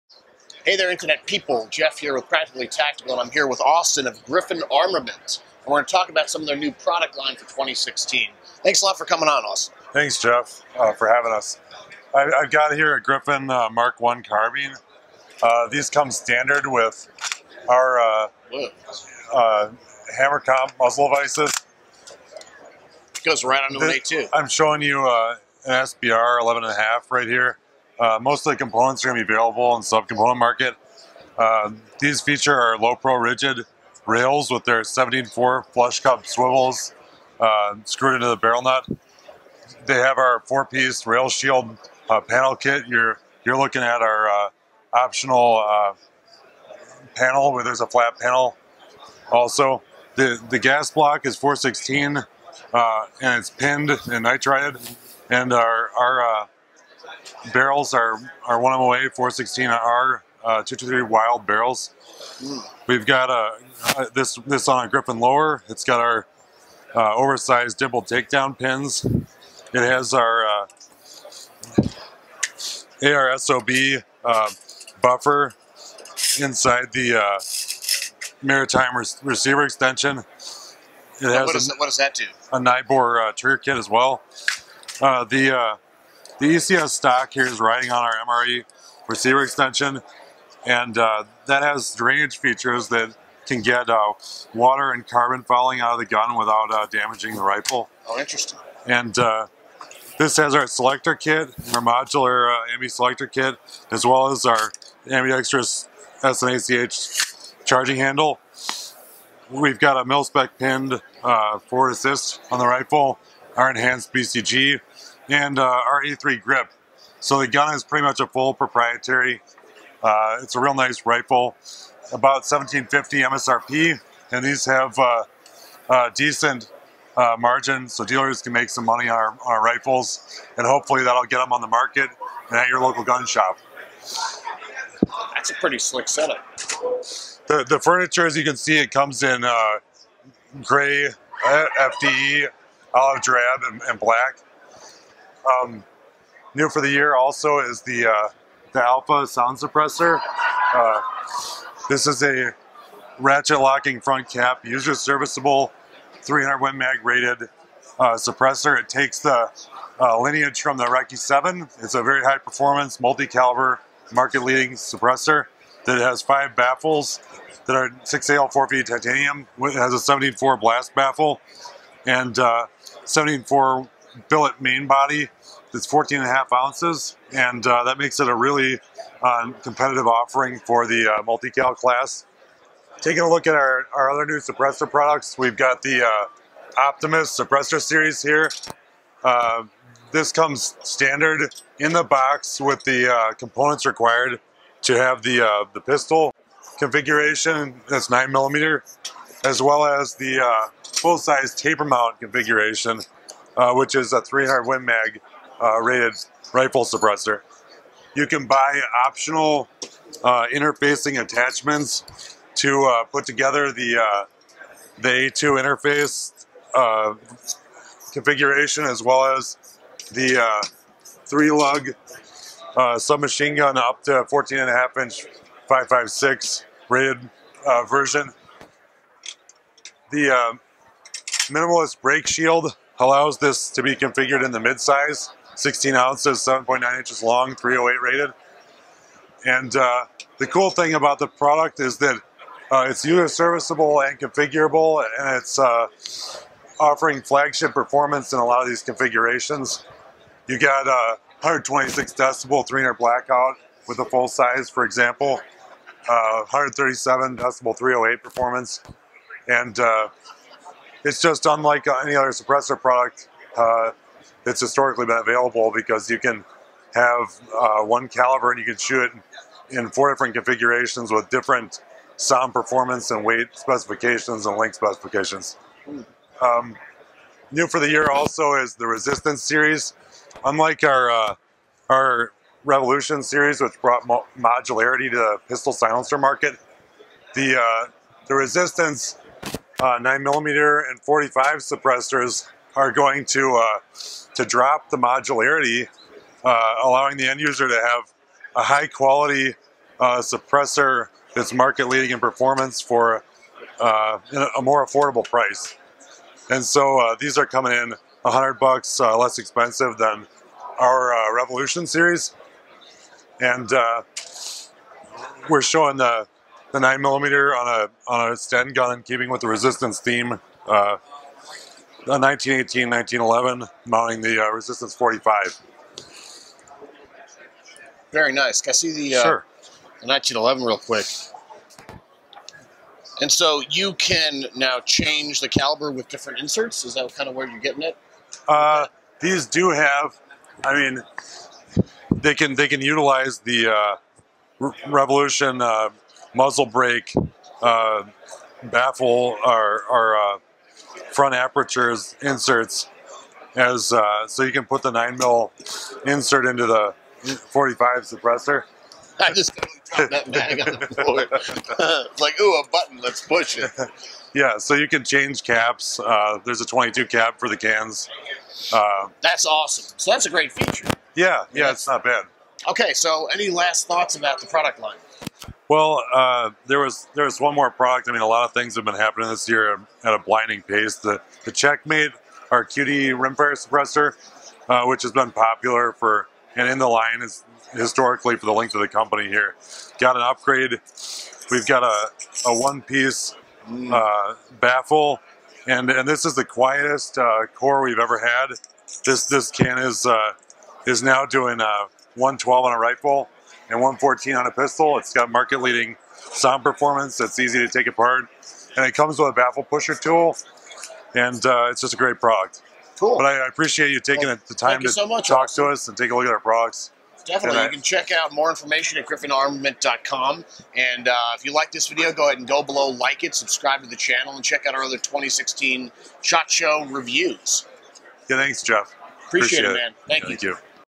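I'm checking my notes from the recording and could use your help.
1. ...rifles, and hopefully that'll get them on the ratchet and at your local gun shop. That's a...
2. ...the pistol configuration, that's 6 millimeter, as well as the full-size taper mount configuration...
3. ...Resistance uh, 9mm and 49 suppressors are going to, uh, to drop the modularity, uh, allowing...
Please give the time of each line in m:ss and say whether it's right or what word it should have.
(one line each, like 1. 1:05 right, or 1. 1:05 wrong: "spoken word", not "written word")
1. 2:09 wrong: "market", not "ratchet"
2. 3:15 wrong: "9", not "6"
3. 4:48 wrong: "45", not "49".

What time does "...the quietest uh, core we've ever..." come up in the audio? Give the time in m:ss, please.
6:36.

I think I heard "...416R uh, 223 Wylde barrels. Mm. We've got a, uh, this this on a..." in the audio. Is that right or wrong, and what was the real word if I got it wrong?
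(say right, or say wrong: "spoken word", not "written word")
right.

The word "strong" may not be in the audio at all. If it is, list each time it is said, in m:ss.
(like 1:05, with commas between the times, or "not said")
not said.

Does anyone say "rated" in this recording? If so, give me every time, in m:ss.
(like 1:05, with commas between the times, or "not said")
2:37, 3:25, 3:46, 3:58.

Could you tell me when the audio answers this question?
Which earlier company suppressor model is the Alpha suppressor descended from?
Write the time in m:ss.
2:40.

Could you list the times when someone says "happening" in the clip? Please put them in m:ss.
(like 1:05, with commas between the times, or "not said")
6:18.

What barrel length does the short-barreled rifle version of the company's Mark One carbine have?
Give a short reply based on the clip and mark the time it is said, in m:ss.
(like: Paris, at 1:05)
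11.5, at 0:26.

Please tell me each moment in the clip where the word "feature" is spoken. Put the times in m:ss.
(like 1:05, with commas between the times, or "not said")
0:32, 1:32, 6:10.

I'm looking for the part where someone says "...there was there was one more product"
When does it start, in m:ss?
6:16.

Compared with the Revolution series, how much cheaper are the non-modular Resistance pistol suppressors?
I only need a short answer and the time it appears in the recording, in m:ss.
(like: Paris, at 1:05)
$100, at 5:08.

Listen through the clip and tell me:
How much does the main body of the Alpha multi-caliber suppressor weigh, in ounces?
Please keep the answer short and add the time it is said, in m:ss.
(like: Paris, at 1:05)
14.5 ounces, at 2:55.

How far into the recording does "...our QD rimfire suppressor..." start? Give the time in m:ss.
6:22.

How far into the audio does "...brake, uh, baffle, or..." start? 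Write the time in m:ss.
5:46.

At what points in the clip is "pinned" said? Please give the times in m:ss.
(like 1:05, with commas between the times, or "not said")
0:53, 1:50.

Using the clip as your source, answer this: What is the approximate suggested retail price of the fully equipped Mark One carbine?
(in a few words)
$1,750.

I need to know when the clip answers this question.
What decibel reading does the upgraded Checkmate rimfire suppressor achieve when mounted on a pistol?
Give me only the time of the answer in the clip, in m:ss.
6:43.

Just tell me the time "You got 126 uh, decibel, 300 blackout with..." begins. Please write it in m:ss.
4:10.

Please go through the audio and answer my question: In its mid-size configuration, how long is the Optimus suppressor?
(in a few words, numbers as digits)
7.9 inches.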